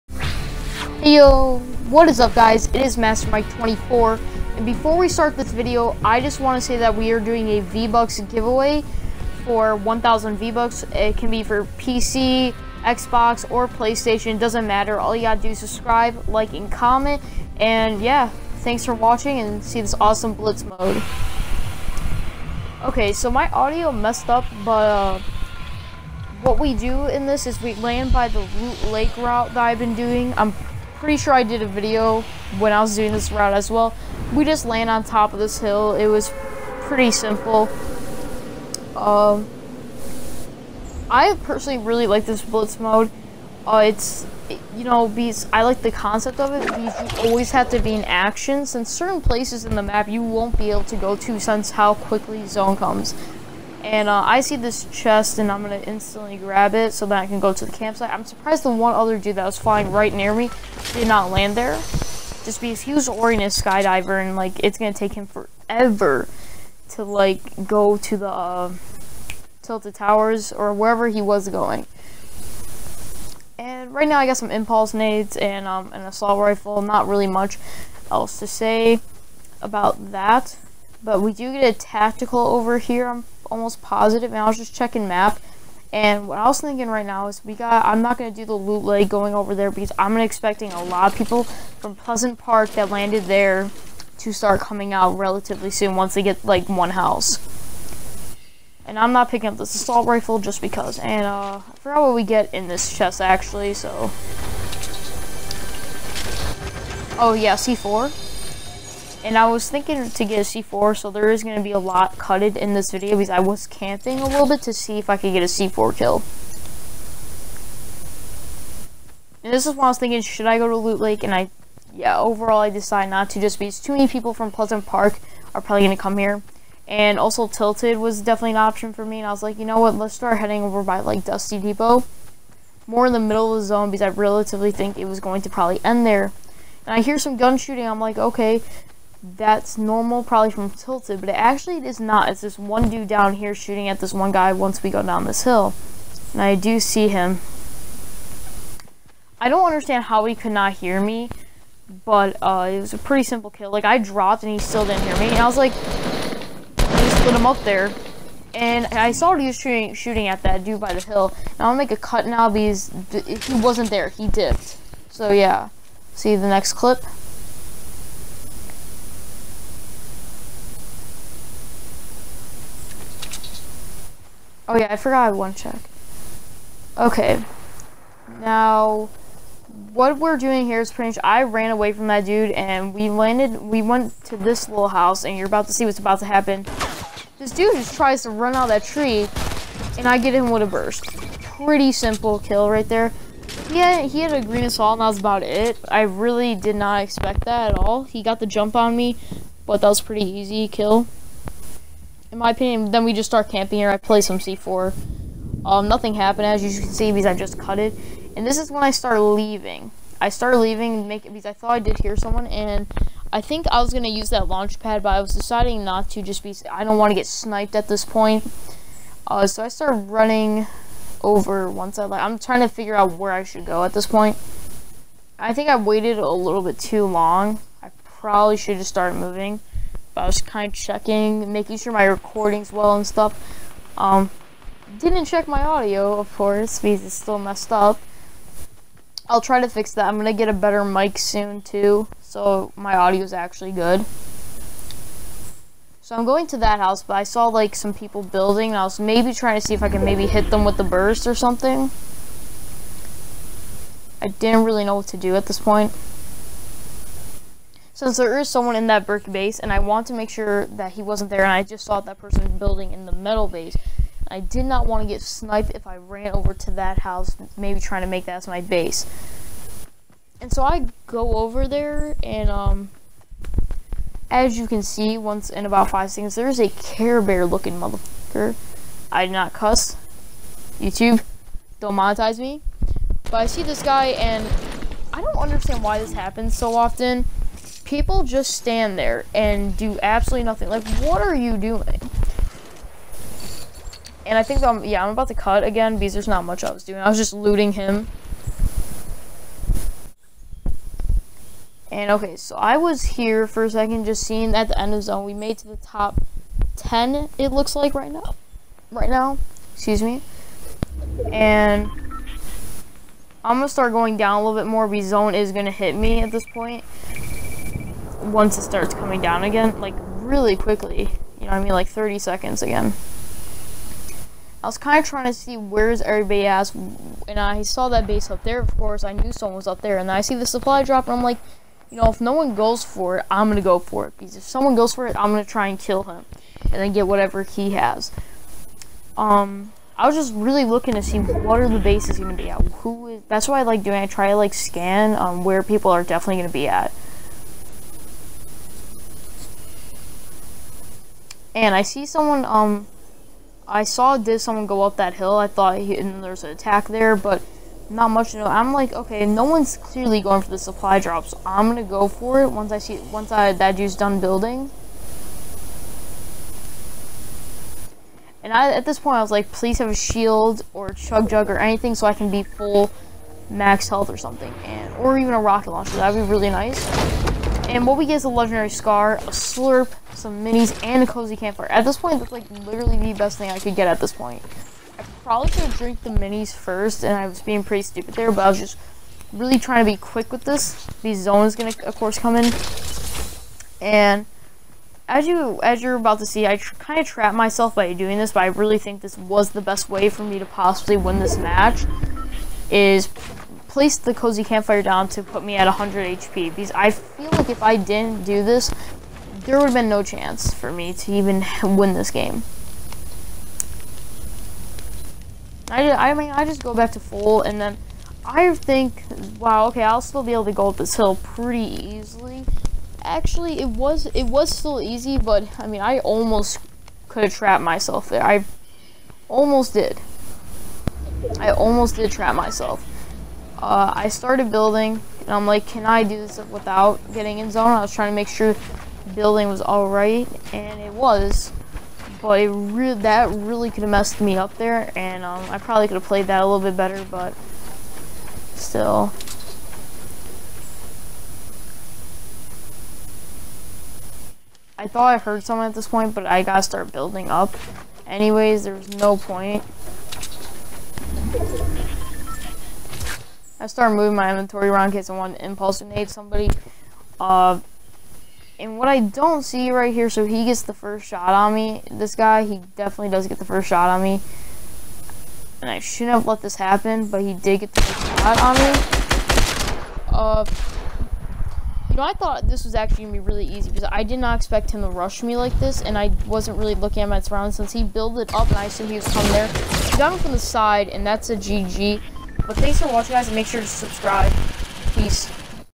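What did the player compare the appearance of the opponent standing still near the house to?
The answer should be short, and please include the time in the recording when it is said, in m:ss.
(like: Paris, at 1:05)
Care Bear, at 4:36.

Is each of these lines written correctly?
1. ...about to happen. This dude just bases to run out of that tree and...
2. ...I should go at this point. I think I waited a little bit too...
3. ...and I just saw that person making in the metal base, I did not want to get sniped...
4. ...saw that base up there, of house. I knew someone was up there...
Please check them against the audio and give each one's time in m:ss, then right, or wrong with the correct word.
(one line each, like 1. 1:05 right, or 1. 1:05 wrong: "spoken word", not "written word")
1. 3:05 wrong: "tries", not "bases"
2. 3:43 right
3. 4:21 wrong: "building", not "making"
4. 5:27 wrong: "course", not "house".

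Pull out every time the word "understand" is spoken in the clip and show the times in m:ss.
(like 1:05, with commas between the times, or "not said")
2:29, 4:45.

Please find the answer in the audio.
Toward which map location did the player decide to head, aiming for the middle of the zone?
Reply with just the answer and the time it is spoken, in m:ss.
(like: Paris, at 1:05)
Dusty Depot, at 2:11.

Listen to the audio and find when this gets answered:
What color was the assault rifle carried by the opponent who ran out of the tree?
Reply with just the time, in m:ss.
3:14.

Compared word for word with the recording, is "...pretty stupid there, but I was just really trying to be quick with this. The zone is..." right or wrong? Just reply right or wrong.
right.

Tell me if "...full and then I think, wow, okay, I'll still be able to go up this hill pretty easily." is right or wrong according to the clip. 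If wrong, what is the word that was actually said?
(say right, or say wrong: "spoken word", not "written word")
right.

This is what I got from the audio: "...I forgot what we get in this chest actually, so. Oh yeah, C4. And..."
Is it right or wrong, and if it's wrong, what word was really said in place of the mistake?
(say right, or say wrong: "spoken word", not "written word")
right.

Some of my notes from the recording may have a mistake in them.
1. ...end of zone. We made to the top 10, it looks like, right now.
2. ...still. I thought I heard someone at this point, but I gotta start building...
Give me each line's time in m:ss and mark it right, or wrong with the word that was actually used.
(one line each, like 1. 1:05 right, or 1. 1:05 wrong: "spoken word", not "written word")
1. 5:04 right
2. 7:28 right.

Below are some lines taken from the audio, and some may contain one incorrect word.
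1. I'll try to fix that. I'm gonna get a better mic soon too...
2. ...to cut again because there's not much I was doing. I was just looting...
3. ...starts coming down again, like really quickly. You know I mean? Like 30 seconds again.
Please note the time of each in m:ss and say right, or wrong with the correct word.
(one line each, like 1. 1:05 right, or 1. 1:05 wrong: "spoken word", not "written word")
1. 3:59 right
2. 4:55 right
3. 5:18 right.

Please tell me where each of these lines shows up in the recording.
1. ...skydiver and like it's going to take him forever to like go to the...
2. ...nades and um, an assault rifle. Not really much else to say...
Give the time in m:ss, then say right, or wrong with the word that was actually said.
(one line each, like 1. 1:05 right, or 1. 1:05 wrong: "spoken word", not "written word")
1. 1:03 right
2. 1:14 right.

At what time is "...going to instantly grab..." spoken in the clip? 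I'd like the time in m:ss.
0:55.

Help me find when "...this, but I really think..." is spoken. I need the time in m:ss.
6:38.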